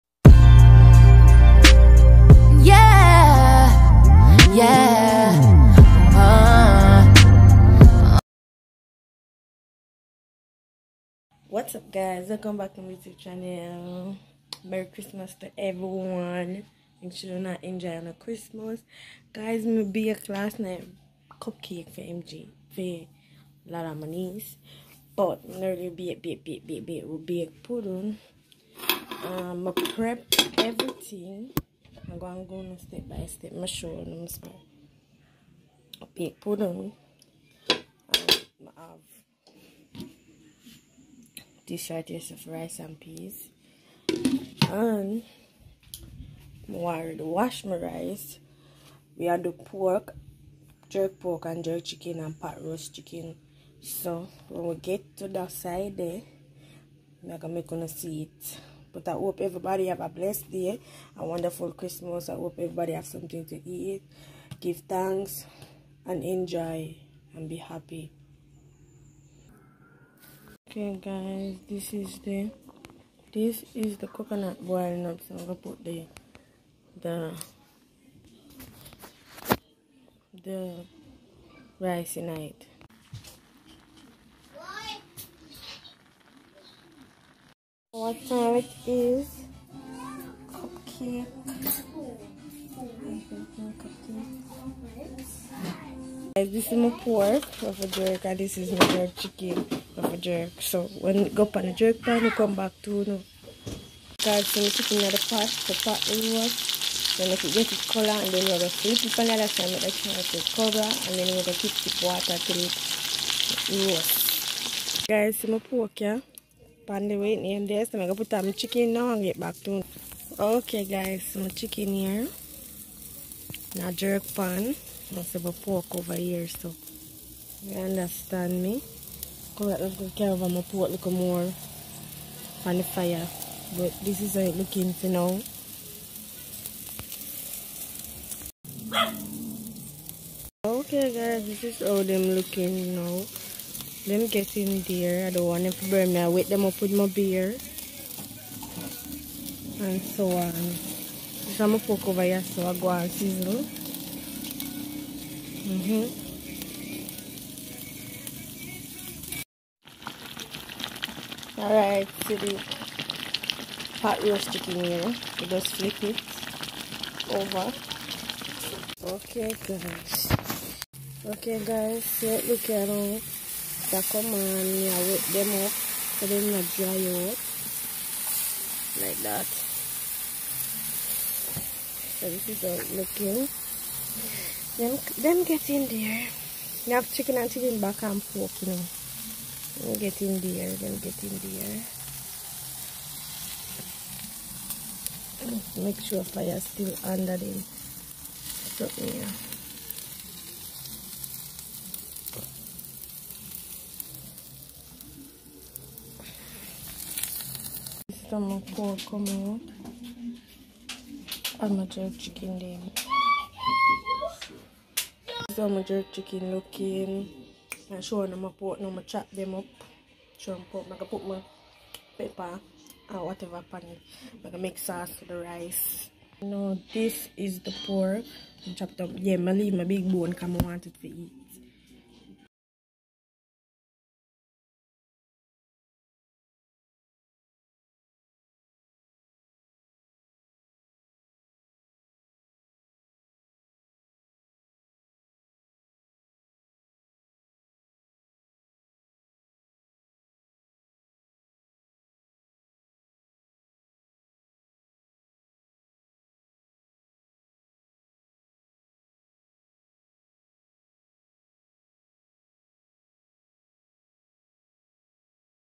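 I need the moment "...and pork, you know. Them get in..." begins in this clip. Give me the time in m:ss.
3:08.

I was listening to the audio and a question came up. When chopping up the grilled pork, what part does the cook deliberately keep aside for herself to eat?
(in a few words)
Big bone.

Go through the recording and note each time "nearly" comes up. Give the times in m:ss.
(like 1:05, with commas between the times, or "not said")
0:25.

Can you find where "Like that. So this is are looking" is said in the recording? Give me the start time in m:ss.
2:59.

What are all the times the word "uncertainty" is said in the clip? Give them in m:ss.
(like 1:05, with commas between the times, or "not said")
not said.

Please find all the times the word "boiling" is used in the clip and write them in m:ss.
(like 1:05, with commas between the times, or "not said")
1:14.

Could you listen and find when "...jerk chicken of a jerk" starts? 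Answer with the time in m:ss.
1:38.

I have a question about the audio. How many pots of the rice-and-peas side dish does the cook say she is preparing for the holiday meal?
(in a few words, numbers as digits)
2.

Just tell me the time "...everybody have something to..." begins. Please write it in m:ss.
1:02.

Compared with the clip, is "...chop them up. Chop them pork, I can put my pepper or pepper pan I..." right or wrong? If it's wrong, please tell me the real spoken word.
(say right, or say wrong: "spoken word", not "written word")
wrong: "whatever", not "pepper".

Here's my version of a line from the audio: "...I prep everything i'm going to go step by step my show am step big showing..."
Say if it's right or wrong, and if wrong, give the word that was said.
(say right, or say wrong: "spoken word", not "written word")
wrong: "pudding", not "showing".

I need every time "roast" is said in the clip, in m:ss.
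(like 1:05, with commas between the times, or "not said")
0:52, 1:53, 2:44.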